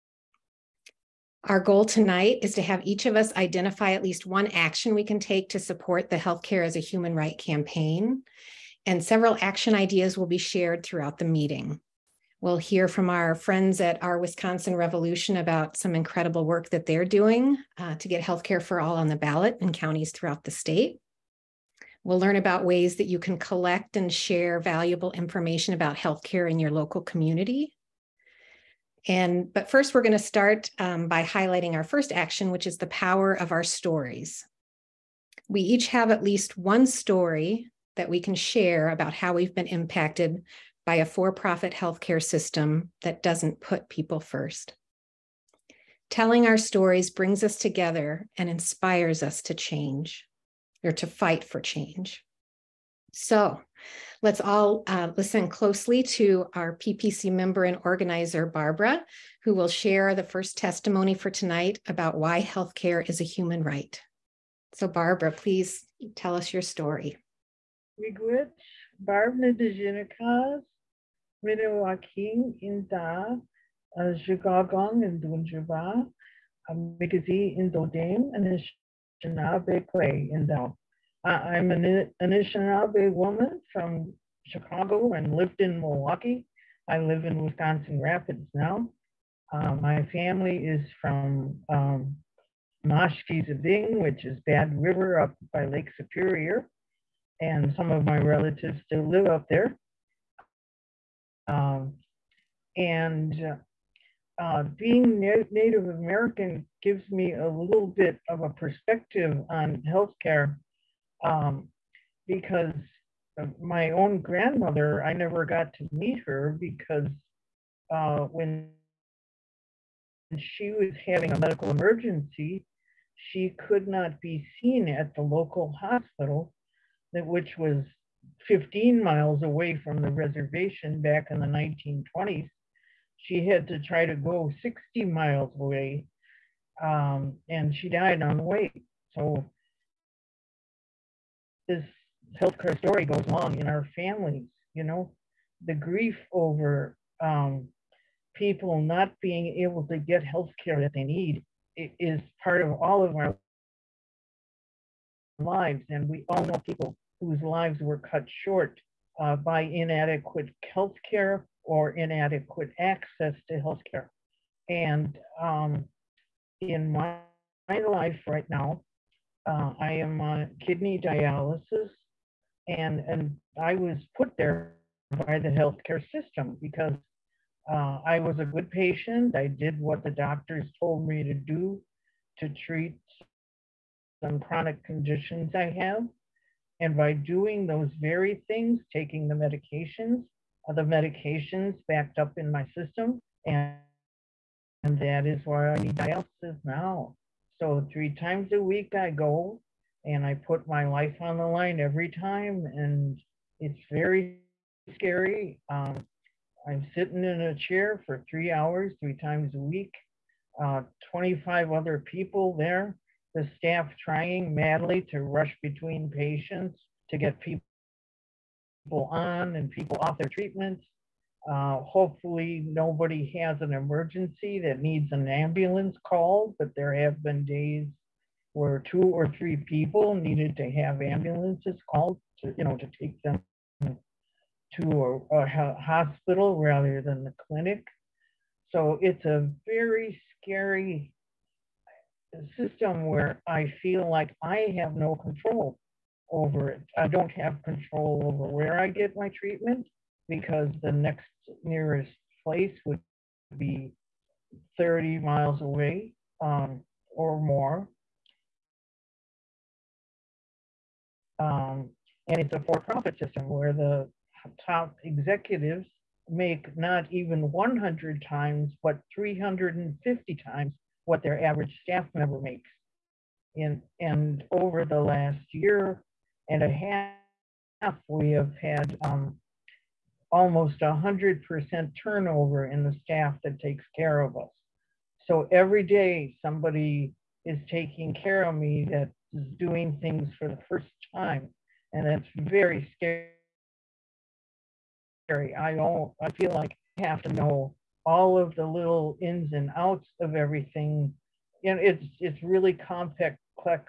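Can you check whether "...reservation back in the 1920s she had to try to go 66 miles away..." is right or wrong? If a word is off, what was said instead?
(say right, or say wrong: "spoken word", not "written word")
wrong: "60", not "66".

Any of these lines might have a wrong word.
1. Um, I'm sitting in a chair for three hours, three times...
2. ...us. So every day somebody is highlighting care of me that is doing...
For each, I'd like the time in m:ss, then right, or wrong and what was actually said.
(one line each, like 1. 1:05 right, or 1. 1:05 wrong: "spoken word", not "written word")
1. 3:25 right
2. 4:44 wrong: "taking", not "highlighting".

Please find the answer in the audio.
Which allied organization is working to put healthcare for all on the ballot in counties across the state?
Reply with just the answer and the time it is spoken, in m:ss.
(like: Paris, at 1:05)
Wisconsin Revolution, at 0:14.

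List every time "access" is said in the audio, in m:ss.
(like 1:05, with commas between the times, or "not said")
2:42.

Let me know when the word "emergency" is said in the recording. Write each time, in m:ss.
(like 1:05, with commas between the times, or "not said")
2:01, 3:43.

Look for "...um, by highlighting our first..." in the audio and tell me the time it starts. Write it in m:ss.
0:30.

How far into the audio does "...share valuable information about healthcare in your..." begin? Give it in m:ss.
0:24.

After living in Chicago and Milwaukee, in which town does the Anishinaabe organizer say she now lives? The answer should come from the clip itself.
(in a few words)
Wisconsin Rapids.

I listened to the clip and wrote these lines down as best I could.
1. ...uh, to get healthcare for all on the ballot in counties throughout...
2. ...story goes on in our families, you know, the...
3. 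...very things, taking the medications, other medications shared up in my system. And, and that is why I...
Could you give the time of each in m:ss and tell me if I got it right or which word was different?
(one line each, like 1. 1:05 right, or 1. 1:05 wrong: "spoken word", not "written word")
1. 0:17 right
2. 2:22 right
3. 3:07 wrong: "backed", not "shared".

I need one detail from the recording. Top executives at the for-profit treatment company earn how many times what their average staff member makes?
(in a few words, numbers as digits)
350 times.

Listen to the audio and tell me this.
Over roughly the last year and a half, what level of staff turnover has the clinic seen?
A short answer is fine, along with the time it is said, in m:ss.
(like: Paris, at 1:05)
almost 100%, at 4:40.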